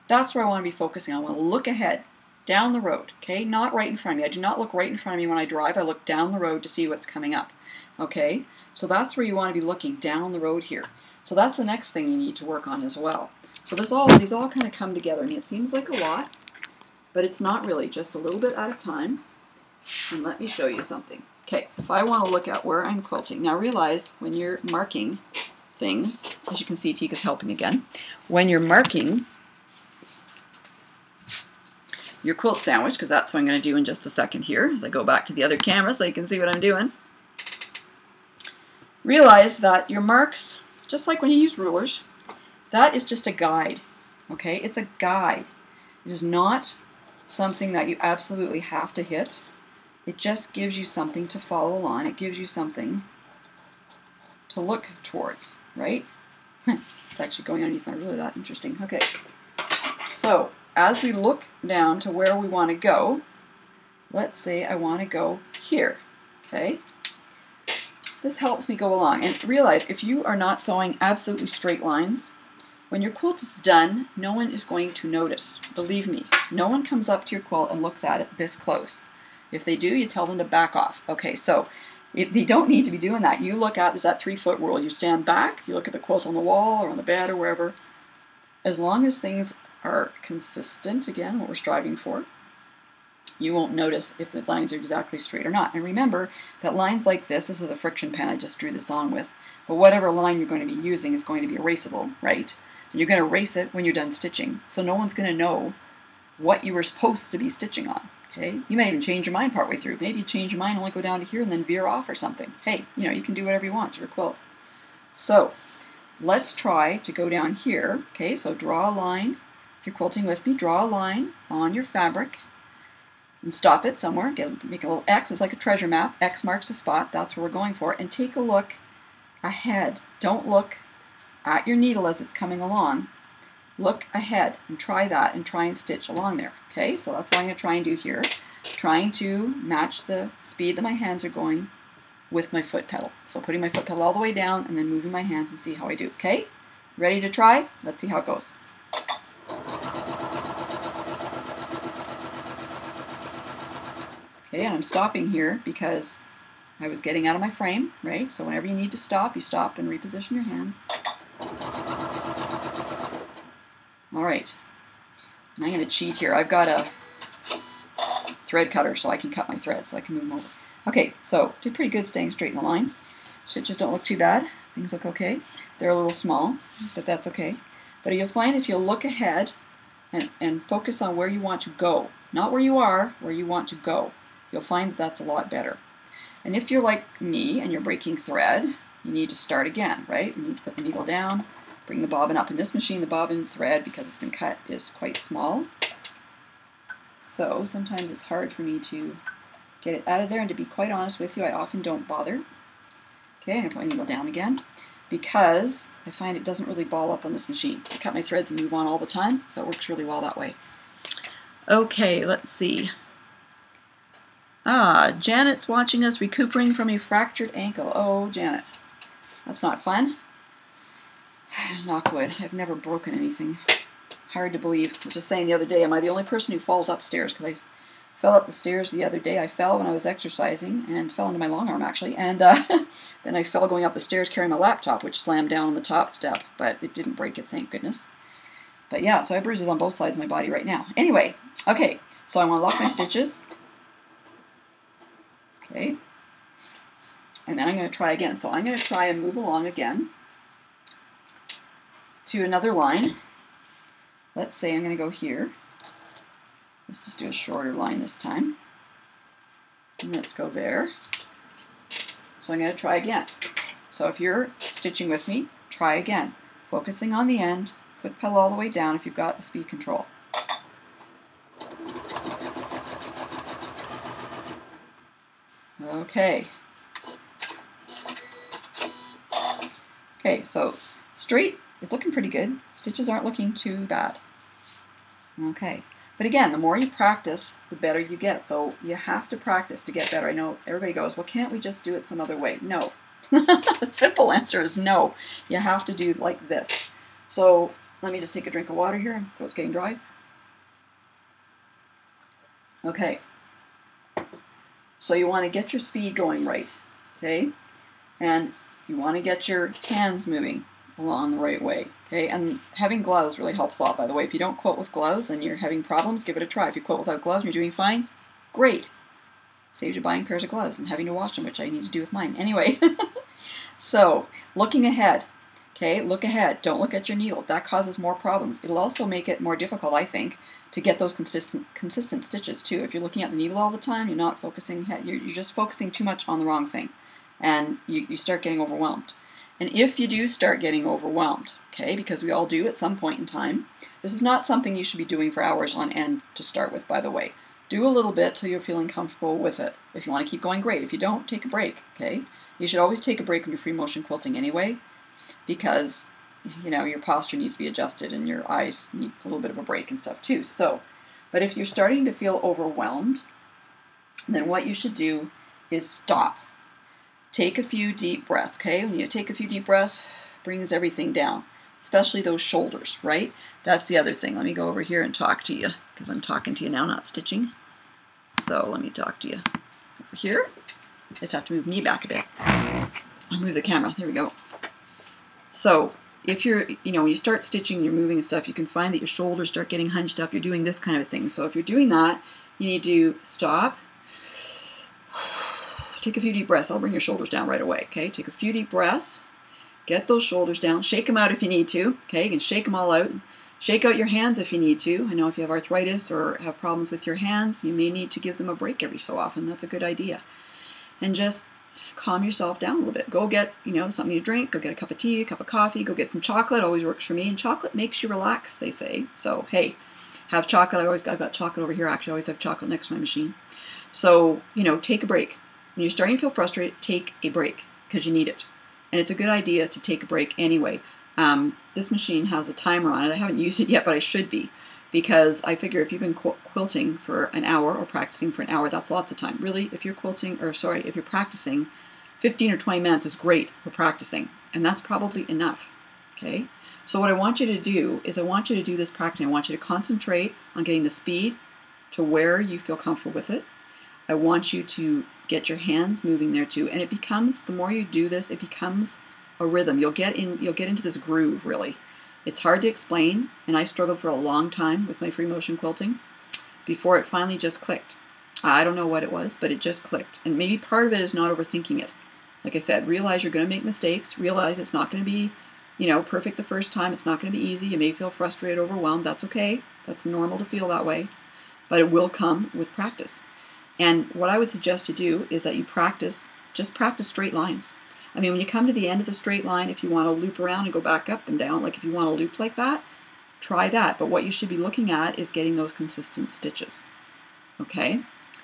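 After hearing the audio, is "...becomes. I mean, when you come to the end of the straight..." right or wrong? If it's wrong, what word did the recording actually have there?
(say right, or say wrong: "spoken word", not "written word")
wrong: "lines", not "becomes".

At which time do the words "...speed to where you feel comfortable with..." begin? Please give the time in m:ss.
7:30.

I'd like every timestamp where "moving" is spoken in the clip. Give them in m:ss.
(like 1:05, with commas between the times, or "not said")
2:24, 5:10, 6:27, 7:36.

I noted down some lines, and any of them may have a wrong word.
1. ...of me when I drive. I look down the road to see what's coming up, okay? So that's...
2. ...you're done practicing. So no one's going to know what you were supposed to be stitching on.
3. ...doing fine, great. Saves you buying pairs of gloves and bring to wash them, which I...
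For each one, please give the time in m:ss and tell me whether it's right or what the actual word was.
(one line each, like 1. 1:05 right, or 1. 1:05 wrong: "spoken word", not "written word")
1. 0:05 right
2. 1:43 wrong: "stitching", not "practicing"
3. 5:17 wrong: "having", not "bring".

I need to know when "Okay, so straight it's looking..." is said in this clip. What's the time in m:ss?
4:40.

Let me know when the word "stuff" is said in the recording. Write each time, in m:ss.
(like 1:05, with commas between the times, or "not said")
5:59, 6:28.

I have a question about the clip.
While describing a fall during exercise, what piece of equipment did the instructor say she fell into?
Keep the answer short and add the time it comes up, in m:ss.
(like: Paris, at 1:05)
long arm, at 3:51.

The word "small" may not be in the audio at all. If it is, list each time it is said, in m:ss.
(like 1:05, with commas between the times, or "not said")
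2:56, 3:15.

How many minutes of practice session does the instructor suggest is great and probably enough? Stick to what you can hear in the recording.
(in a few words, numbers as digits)
15 or 20 minutes.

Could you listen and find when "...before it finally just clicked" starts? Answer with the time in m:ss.
7:46.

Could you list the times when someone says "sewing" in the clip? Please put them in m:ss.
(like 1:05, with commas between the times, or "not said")
1:10.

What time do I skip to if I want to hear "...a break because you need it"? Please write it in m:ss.
7:07.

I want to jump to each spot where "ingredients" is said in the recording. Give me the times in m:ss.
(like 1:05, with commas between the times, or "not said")
not said.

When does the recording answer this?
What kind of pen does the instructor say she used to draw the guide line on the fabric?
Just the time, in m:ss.
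1:37.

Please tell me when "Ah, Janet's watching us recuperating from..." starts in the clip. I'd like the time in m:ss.
3:34.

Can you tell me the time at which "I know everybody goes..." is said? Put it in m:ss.
4:50.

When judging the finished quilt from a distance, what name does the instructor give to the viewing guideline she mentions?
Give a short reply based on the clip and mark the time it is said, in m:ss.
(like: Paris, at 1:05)
three foot rule, at 1:24.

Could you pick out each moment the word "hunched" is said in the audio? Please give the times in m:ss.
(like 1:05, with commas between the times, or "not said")
6:29.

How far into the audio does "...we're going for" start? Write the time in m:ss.
2:07.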